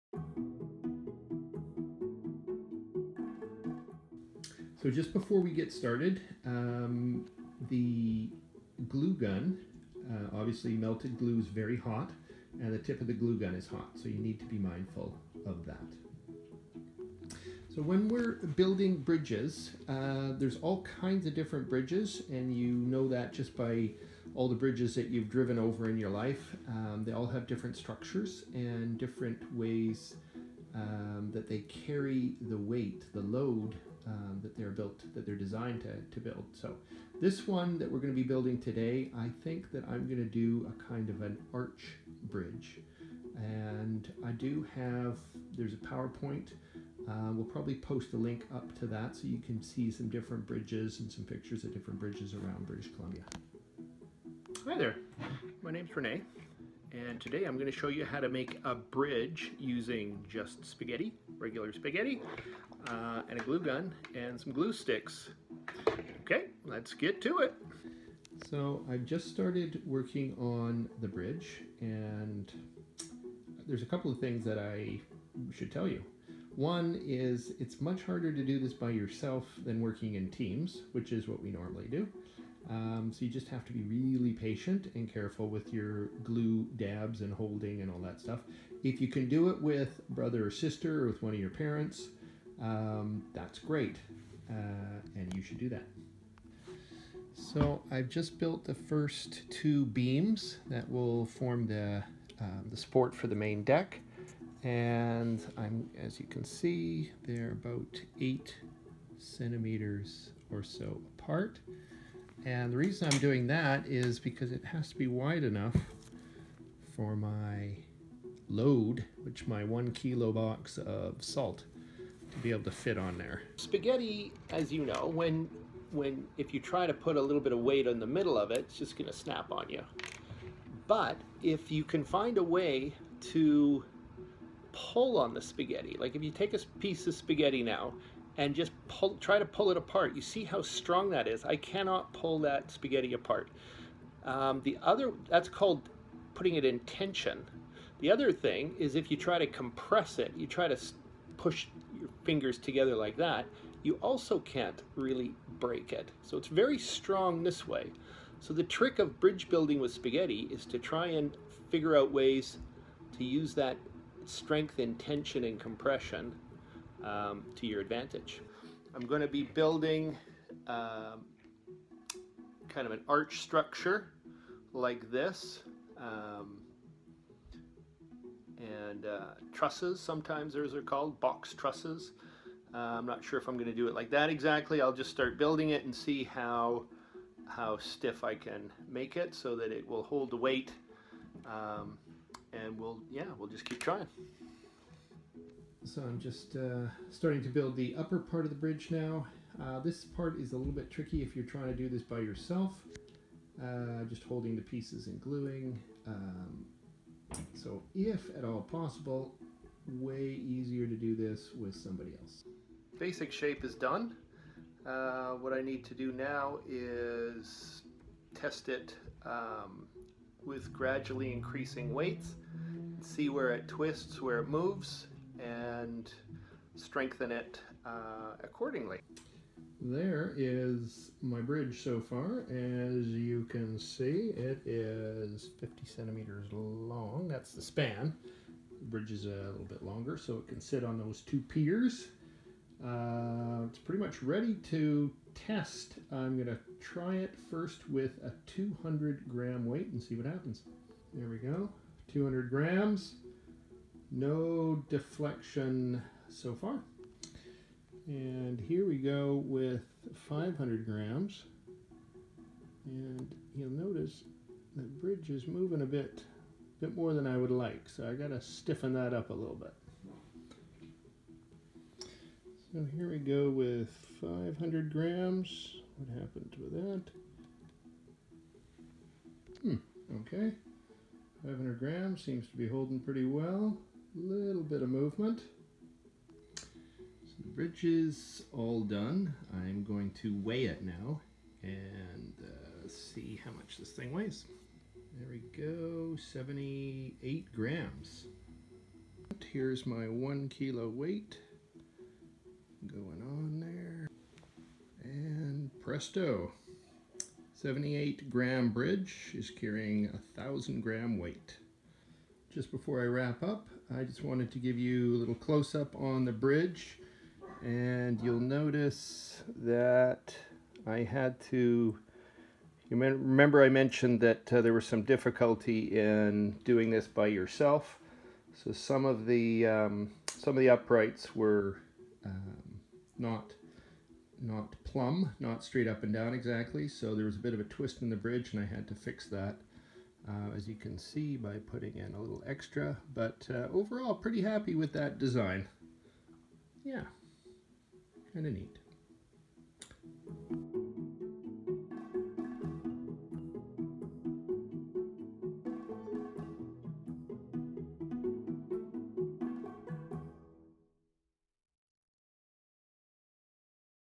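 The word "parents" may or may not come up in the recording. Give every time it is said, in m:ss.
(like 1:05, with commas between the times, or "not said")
1:31.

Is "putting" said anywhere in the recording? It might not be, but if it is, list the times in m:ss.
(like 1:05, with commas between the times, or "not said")
2:26, 5:41.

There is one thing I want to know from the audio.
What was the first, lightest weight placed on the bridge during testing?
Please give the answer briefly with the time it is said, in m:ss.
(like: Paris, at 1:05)
200 grams, at 4:08.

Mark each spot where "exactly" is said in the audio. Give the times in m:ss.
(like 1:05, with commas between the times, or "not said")
3:04, 5:36.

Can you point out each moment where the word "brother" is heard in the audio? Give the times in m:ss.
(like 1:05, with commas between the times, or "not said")
1:30.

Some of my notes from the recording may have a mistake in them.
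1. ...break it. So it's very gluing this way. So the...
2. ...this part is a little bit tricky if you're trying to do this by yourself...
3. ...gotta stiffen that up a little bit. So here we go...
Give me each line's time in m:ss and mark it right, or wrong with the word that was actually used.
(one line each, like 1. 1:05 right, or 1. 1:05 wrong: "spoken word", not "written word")
1. 2:35 wrong: "strong", not "gluing"
2. 3:19 right
3. 4:28 right.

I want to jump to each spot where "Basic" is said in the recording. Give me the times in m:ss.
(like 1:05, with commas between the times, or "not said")
3:32.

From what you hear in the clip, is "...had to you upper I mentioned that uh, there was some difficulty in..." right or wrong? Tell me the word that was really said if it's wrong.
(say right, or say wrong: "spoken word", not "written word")
wrong: "remember", not "upper".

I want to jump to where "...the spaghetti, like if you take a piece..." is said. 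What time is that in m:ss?
2:15.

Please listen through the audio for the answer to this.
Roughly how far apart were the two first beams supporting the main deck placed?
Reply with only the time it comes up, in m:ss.
1:48.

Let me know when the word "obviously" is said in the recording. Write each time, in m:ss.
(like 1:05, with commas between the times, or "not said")
0:10.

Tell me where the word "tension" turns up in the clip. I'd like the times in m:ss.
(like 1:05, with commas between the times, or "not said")
2:26, 2:44.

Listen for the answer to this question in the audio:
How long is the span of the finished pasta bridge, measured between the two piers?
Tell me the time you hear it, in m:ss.
3:55.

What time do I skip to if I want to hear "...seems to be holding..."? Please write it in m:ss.
4:42.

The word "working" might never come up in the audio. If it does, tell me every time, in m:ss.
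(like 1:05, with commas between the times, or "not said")
1:09, 1:19.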